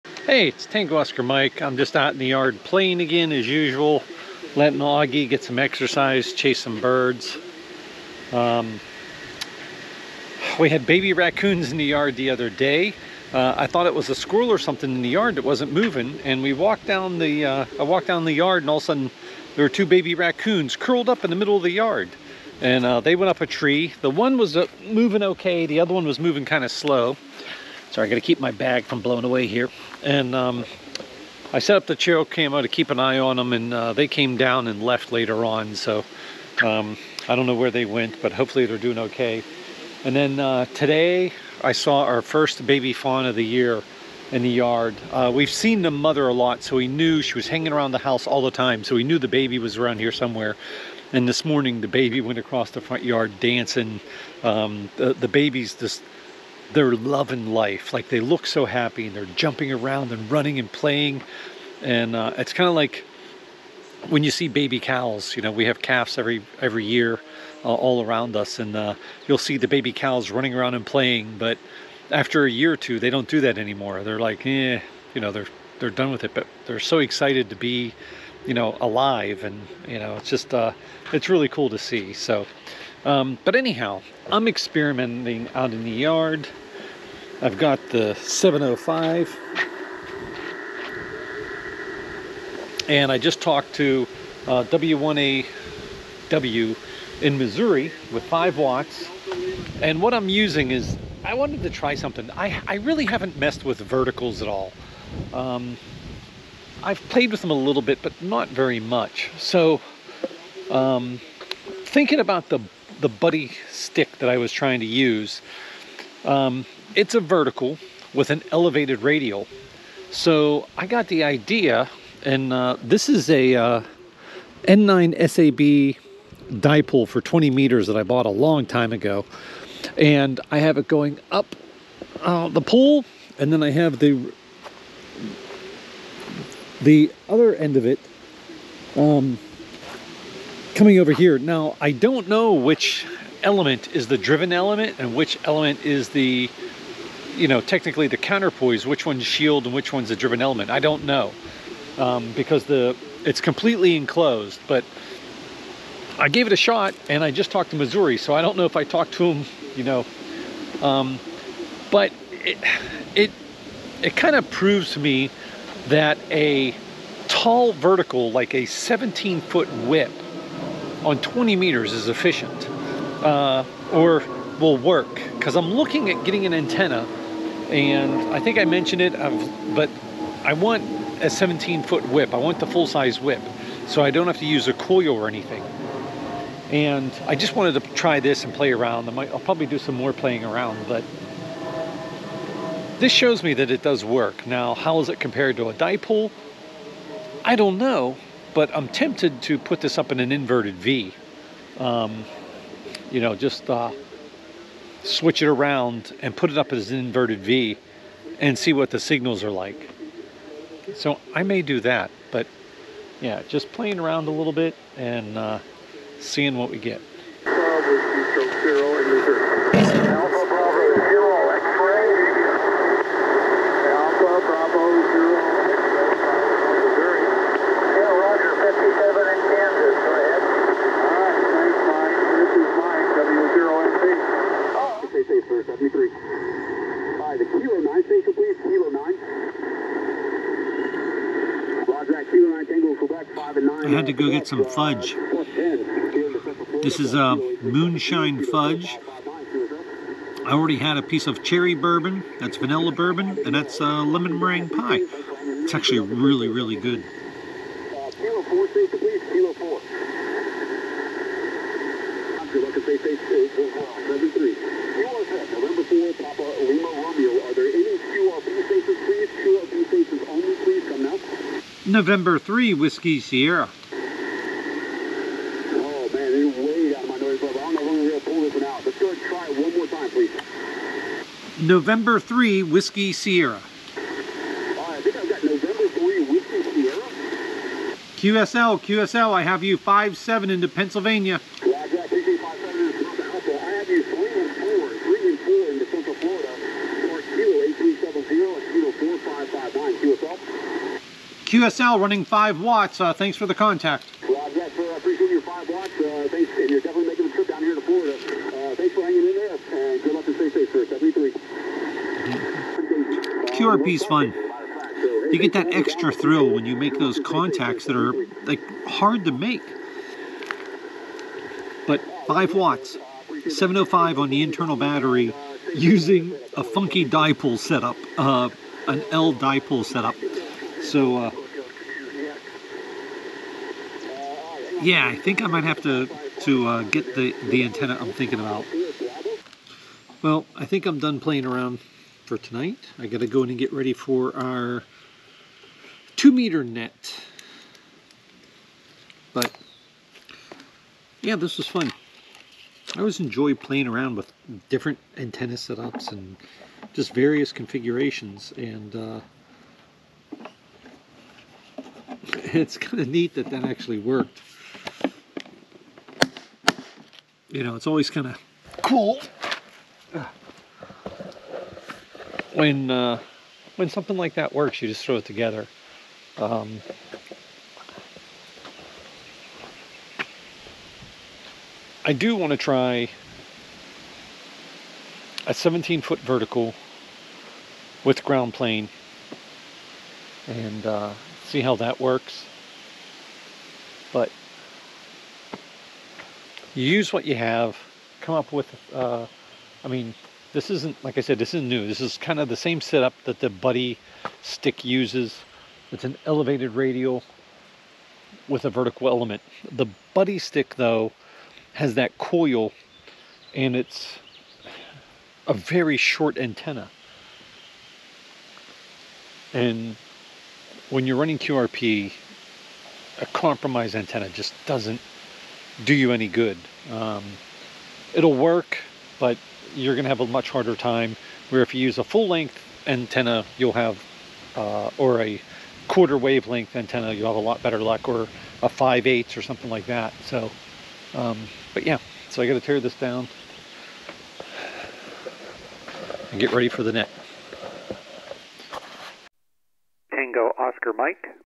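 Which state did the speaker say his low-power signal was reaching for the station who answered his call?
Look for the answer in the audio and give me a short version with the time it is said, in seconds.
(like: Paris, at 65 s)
Florida, at 307 s.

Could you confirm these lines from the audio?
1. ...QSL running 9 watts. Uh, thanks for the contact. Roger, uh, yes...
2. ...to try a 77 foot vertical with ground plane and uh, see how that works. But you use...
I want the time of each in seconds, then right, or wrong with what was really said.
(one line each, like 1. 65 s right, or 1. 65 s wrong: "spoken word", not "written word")
1. 301 s wrong: "5", not "9"
2. 382 s wrong: "17", not "77".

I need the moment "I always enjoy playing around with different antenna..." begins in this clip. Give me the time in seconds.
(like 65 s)
352 s.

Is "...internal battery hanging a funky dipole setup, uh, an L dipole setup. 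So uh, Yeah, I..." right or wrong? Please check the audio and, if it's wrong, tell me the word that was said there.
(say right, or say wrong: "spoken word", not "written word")
wrong: "using", not "hanging".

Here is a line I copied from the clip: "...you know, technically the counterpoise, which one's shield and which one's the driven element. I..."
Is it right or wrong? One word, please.
right.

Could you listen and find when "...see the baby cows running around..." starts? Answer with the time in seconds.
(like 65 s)
69 s.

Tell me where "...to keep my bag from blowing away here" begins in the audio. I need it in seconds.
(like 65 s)
28 s.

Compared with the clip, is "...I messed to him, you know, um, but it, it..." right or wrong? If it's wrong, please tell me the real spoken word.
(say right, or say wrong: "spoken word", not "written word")
wrong: "talked", not "messed".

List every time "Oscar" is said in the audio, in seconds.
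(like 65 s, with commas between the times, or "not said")
0 s, 450 s.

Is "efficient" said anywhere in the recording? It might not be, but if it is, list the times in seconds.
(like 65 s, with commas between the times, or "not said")
172 s.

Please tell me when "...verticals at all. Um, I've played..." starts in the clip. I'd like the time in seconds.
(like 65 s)
103 s.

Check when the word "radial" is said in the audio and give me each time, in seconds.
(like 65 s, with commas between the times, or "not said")
119 s, 406 s.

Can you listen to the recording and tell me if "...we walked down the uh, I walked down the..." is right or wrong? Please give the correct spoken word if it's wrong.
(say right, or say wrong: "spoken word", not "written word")
right.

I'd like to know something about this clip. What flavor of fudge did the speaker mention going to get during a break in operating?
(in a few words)
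moonshine.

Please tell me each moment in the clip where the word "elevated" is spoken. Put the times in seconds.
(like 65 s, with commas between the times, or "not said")
118 s, 406 s.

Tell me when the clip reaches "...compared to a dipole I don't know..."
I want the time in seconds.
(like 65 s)
195 s.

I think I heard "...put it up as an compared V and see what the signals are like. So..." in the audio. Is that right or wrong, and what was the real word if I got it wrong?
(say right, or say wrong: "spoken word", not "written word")
wrong: "inverted", not "compared".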